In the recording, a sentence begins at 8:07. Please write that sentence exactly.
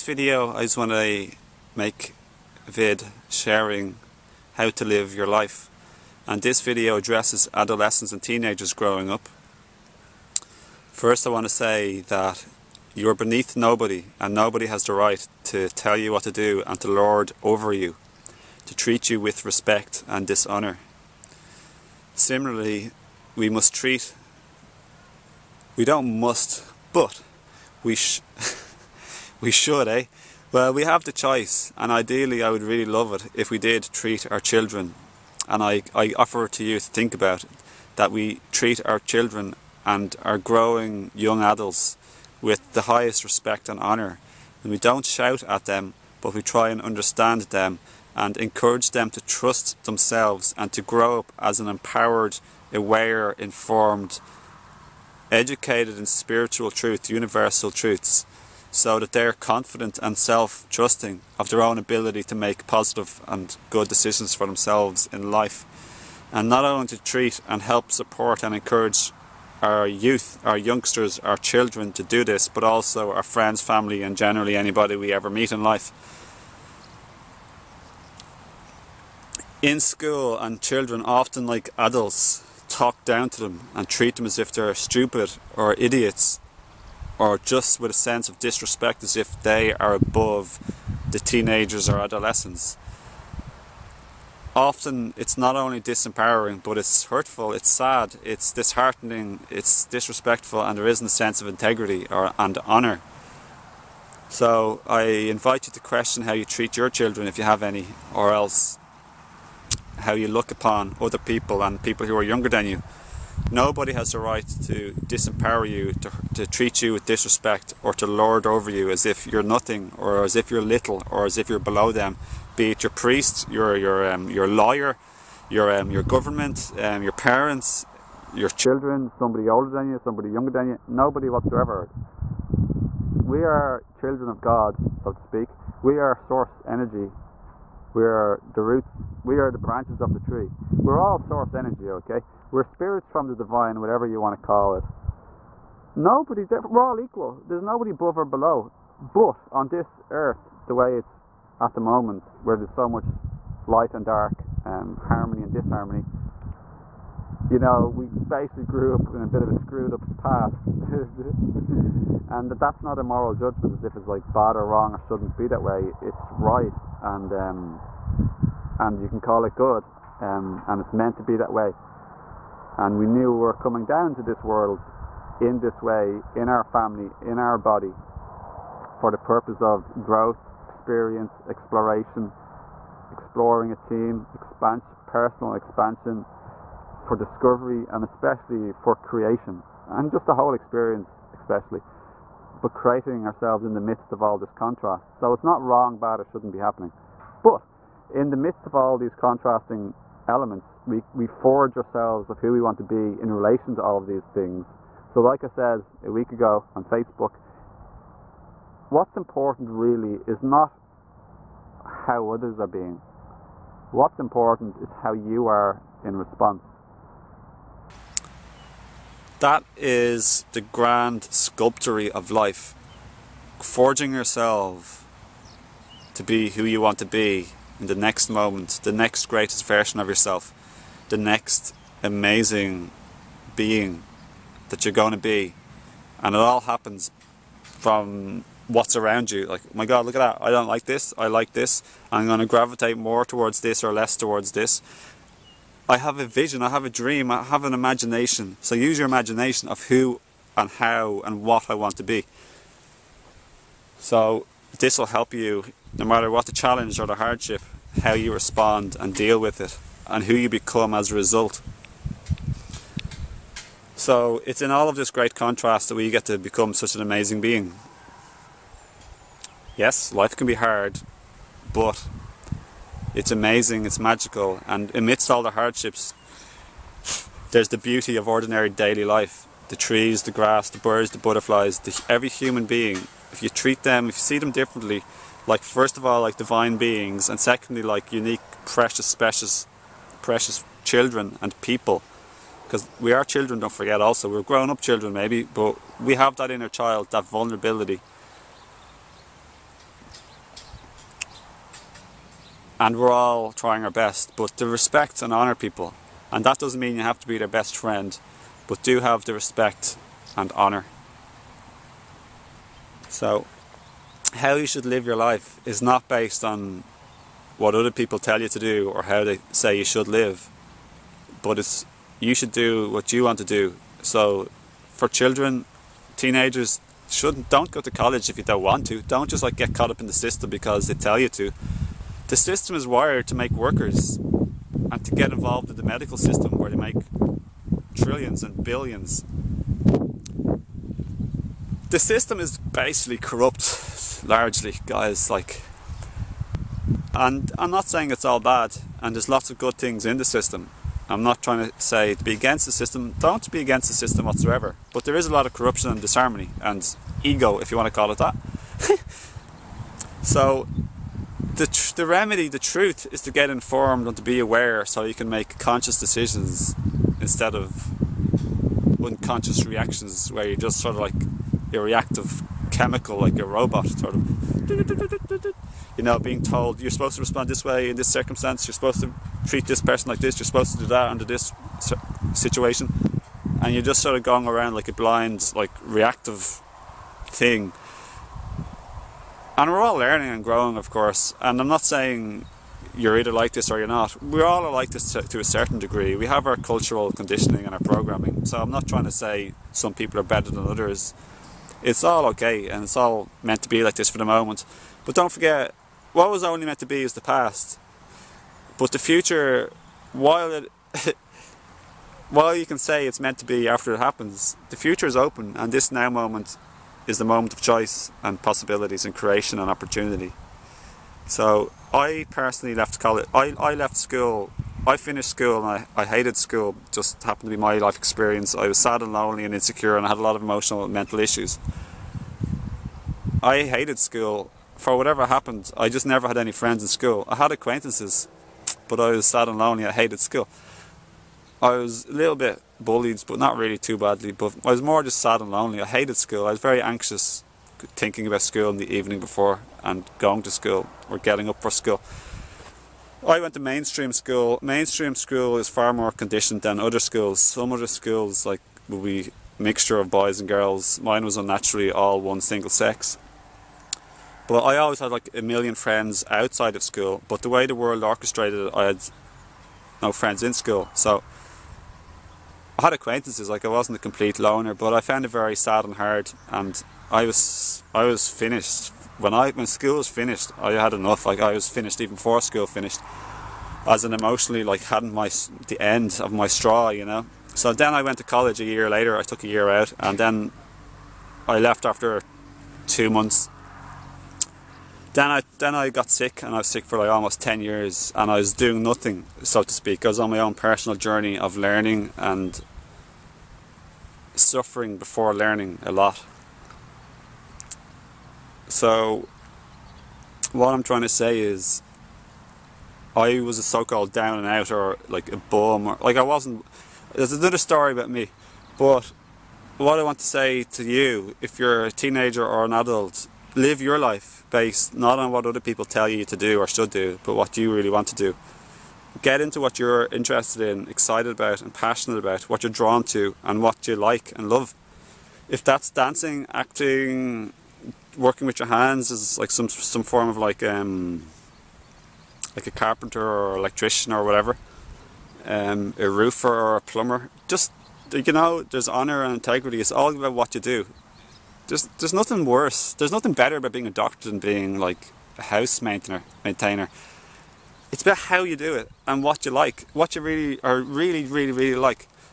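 So then I went to college a year later.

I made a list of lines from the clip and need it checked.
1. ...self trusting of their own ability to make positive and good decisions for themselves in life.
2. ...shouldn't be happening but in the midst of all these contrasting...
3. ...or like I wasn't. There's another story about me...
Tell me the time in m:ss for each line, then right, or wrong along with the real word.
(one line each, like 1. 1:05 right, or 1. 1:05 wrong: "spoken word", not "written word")
1. 1:00 right
2. 3:16 right
3. 8:35 right.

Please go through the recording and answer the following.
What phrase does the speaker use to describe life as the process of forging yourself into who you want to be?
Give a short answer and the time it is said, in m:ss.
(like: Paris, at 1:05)
grand sculptory of life, at 3:40.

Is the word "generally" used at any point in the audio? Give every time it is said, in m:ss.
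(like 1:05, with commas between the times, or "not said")
1:14.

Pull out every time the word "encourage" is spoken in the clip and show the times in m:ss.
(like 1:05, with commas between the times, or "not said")
0:48, 1:08.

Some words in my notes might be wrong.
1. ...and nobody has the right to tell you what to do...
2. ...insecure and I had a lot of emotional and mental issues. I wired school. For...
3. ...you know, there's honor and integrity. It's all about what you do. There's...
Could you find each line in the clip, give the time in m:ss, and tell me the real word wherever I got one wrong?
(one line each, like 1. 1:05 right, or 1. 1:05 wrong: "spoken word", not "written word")
1. 0:14 right
2. 7:09 wrong: "hated", not "wired"
3. 9:08 right.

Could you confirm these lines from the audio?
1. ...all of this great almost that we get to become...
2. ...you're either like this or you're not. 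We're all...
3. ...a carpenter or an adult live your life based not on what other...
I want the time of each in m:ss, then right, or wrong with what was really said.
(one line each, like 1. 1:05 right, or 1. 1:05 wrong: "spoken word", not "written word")
1. 4:24 wrong: "contrast", not "almost"
2. 6:32 right
3. 8:41 wrong: "teenager", not "carpenter".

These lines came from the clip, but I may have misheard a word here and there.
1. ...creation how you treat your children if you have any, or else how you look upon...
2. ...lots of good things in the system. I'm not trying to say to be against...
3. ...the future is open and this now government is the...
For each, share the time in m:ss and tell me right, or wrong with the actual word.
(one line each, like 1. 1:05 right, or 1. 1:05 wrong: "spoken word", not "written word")
1. 1:45 wrong: "question", not "creation"
2. 5:49 right
3. 6:54 wrong: "moment", not "government".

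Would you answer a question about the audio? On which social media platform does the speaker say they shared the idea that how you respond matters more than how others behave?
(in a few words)
Facebook.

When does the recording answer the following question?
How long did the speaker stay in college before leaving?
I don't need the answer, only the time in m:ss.
8:12.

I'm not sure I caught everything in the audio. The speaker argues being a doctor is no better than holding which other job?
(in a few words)
house maintainer.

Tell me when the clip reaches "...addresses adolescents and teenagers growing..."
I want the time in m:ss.
0:06.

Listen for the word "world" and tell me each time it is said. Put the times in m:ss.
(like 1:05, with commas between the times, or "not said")
2:54, 7:47.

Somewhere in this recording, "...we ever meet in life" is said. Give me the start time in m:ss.
1:14.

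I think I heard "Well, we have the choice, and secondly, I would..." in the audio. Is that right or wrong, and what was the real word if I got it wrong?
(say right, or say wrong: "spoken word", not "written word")
wrong: "ideally", not "secondly".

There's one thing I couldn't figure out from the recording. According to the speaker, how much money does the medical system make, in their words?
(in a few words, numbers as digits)
trillions and billions.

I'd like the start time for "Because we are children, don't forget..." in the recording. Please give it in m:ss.
4:52.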